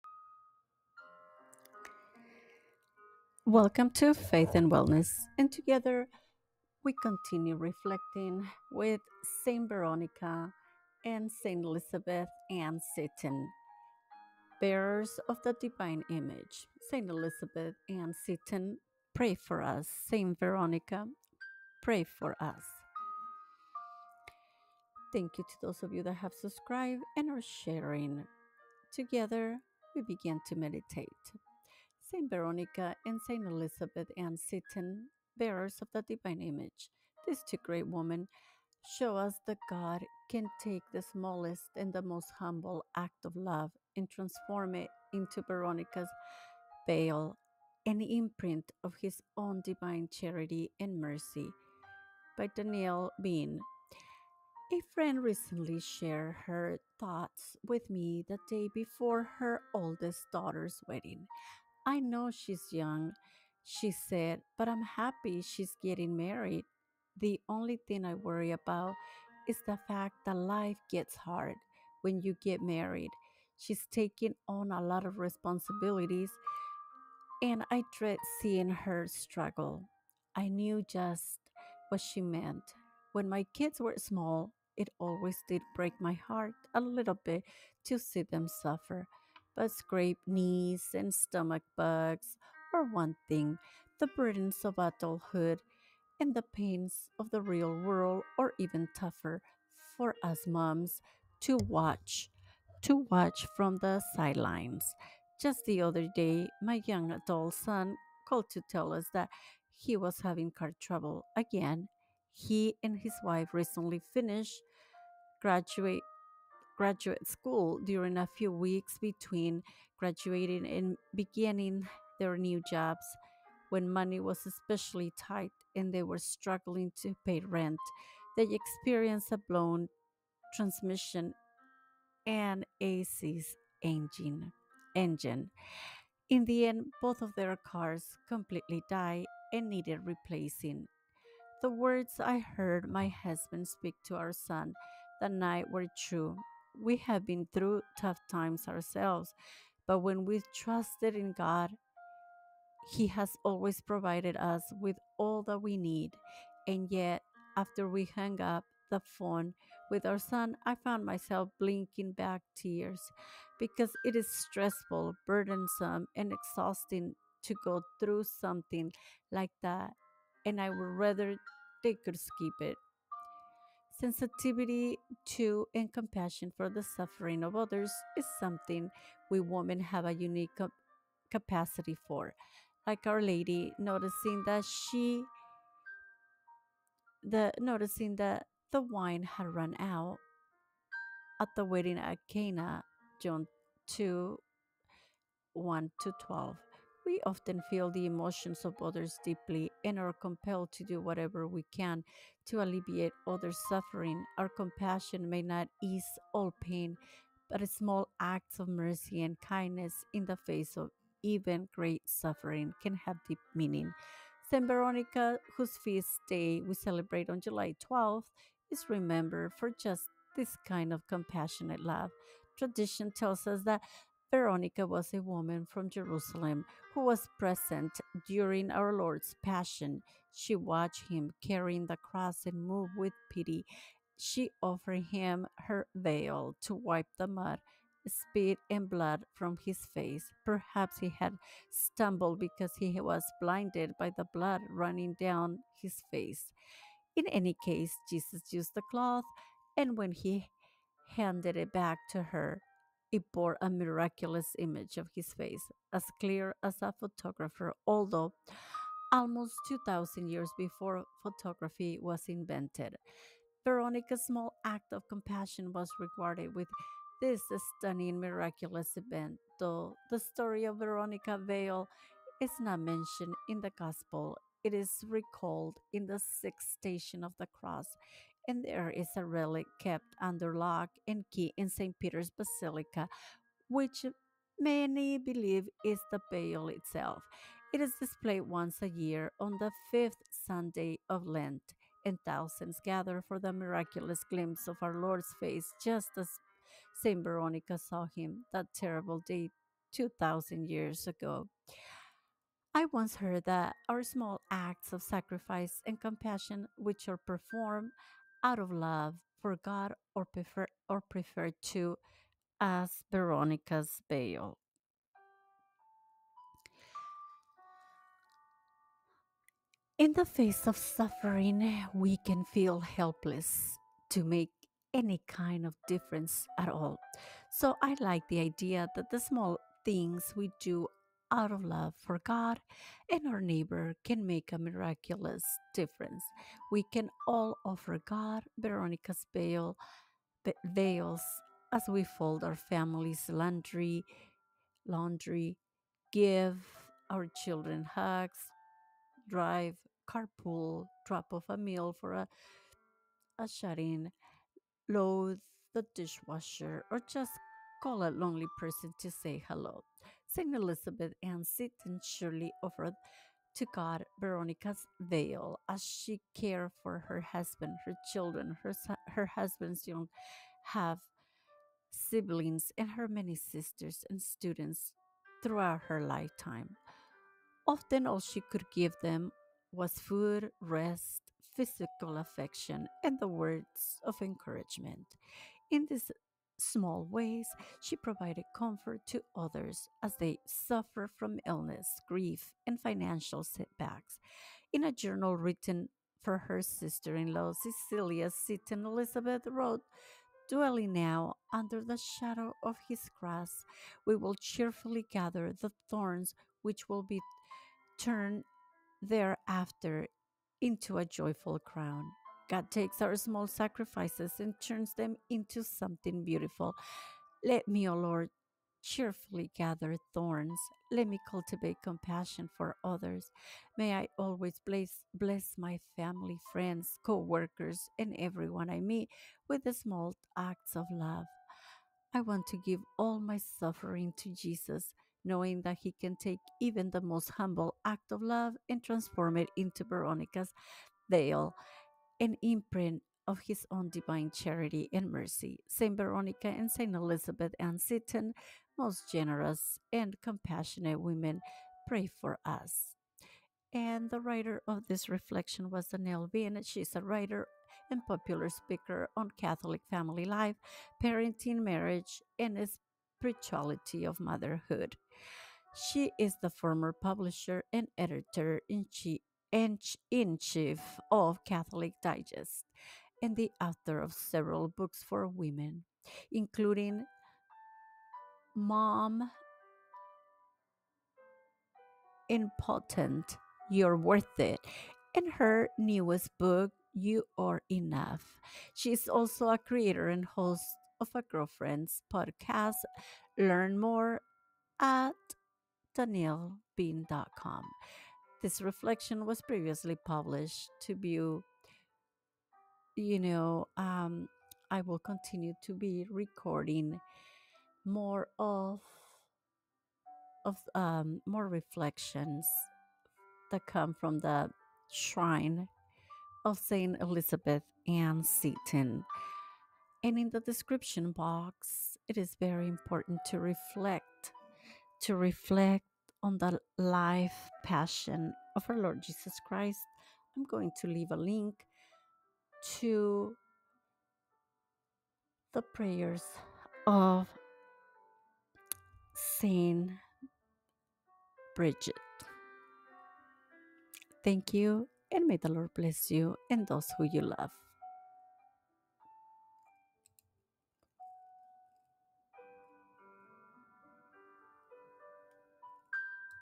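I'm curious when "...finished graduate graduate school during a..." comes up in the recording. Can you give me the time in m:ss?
1:54.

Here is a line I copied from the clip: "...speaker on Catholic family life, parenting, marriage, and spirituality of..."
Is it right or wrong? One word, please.
right.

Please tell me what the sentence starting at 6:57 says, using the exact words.
Let me, O oh Lord, cheerfully gather thorns.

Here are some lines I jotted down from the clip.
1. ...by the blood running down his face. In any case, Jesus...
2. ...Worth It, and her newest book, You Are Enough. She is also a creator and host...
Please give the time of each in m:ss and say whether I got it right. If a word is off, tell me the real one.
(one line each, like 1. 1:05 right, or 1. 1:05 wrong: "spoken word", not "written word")
1. 4:03 right
2. 8:03 right.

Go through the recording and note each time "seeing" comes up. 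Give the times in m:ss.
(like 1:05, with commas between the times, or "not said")
1:18.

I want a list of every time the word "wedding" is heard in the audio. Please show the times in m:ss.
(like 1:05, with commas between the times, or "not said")
1:00, 3:11.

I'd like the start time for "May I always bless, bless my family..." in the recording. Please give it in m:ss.
7:03.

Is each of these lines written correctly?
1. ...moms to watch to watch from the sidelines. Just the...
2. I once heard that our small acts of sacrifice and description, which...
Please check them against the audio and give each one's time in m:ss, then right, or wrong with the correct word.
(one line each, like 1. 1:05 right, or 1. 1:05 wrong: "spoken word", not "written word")
1. 1:40 right
2. 5:02 wrong: "compassion", not "description".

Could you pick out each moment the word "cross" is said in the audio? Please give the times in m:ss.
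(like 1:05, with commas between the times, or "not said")
3:51, 4:37, 6:43.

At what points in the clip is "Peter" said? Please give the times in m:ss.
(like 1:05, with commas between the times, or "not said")
4:41.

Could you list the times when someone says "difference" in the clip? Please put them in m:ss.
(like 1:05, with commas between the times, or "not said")
5:25, 5:35.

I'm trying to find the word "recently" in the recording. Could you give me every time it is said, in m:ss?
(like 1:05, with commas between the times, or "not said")
0:55, 1:53.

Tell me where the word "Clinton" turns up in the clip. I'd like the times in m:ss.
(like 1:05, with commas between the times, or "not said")
not said.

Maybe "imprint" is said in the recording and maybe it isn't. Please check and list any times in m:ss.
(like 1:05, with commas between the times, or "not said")
0:48, 7:22.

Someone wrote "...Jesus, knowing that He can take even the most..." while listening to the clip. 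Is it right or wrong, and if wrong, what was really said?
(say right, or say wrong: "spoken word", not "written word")
right.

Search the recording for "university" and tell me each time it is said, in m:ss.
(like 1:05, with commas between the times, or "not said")
not said.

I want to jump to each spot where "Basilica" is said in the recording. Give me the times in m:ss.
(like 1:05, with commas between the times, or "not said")
4:42.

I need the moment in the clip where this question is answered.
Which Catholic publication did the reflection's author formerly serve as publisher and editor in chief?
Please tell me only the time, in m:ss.
7:51.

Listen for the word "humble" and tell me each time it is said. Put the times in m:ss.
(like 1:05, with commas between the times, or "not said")
0:42, 7:17.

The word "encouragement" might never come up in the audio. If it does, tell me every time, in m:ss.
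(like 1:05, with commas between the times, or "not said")
6:24.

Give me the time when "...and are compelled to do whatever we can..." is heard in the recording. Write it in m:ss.
3:19.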